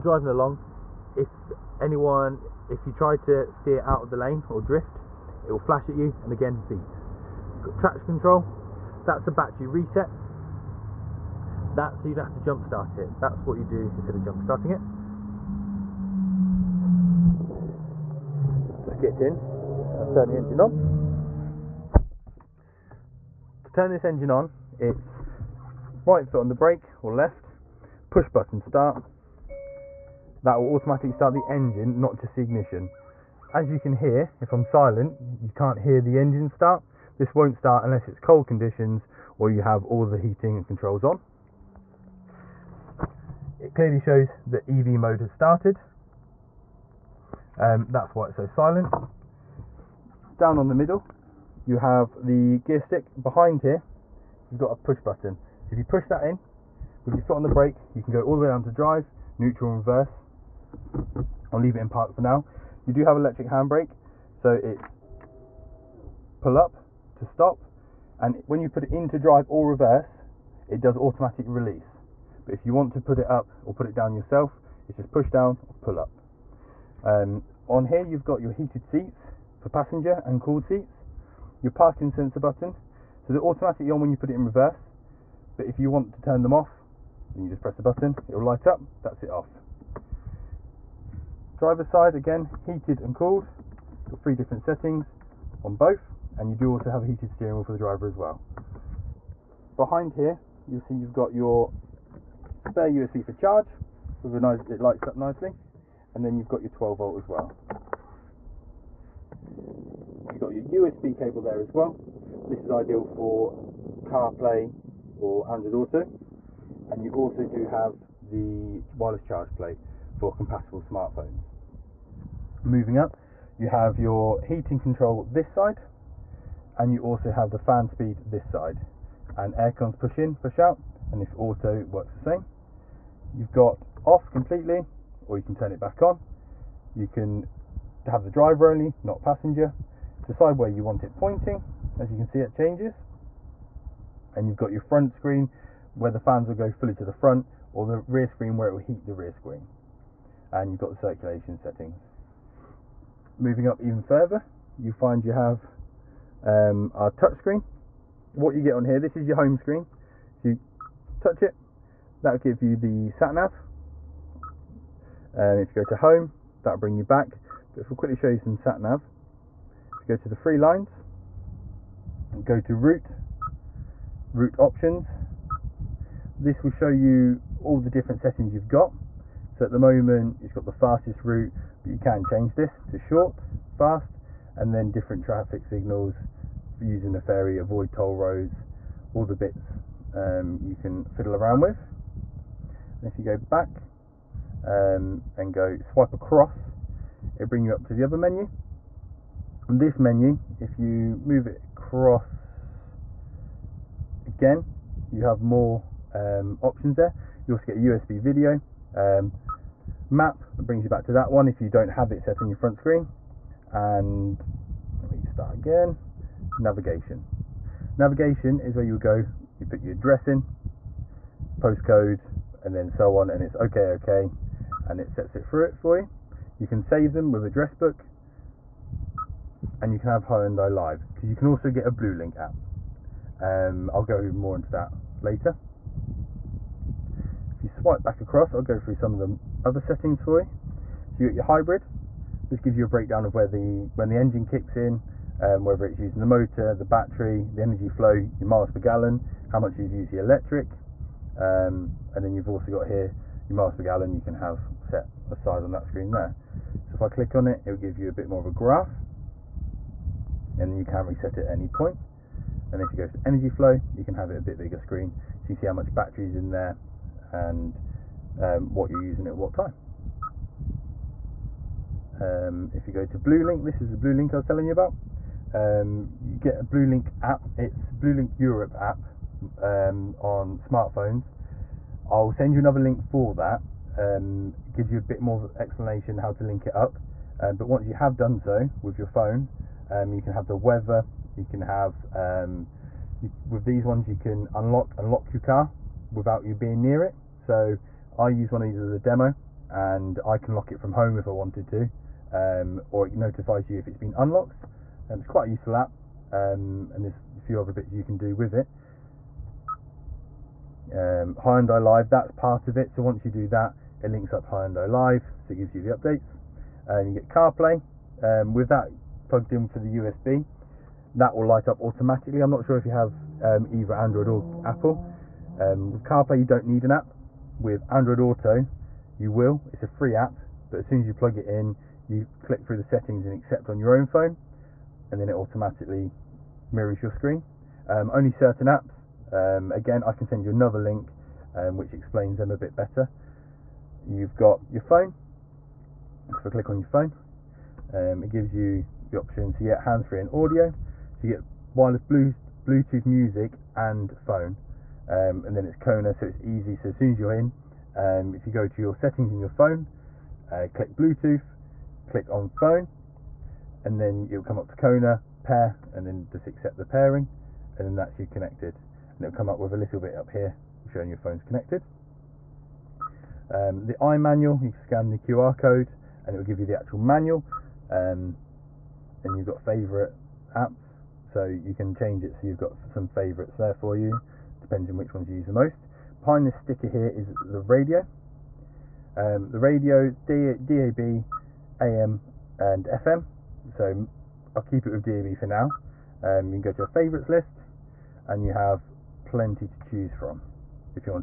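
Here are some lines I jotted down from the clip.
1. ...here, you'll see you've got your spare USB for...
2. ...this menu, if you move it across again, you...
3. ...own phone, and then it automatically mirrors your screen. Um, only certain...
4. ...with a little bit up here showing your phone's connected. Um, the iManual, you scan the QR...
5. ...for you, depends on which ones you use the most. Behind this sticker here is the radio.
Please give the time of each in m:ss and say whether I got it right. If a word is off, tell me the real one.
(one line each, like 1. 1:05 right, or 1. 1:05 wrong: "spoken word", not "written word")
1. 1:40 right
2. 3:19 right
3. 5:33 right
4. 6:09 right
5. 6:23 right.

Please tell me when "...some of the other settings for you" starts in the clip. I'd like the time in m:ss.
3:58.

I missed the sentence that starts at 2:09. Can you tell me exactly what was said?
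And aircons push in, push out, and if auto works the same.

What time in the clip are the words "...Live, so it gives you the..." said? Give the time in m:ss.
5:14.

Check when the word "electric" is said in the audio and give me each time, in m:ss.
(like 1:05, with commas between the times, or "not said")
1:03, 4:10.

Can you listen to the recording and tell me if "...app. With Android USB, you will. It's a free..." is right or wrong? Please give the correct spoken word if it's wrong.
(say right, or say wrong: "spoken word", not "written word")
wrong: "Auto", not "USB".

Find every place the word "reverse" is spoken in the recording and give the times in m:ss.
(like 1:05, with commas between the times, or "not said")
0:59, 1:09, 1:24.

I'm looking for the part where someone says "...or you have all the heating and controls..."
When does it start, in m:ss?
0:39.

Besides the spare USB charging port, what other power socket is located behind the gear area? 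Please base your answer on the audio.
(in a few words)
12 volt.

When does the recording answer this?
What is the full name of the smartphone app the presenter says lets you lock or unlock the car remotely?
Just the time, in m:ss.
4:37.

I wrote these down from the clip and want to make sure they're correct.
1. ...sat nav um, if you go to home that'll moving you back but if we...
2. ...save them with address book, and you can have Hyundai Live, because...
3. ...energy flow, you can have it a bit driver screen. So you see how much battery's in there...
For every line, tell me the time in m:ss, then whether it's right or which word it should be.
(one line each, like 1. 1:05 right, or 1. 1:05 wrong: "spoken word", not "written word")
1. 2:43 wrong: "bring", not "moving"
2. 3:46 right
3. 4:23 wrong: "bigger", not "driver".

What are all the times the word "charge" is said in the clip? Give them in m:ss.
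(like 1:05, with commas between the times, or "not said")
1:43, 1:59.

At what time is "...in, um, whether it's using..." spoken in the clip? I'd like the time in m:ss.
4:04.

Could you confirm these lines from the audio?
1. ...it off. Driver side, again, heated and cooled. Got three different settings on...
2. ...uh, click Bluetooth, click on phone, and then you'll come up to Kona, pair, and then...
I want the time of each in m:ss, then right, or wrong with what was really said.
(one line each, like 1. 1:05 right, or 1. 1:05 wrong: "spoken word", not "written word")
1. 1:29 right
2. 6:00 right.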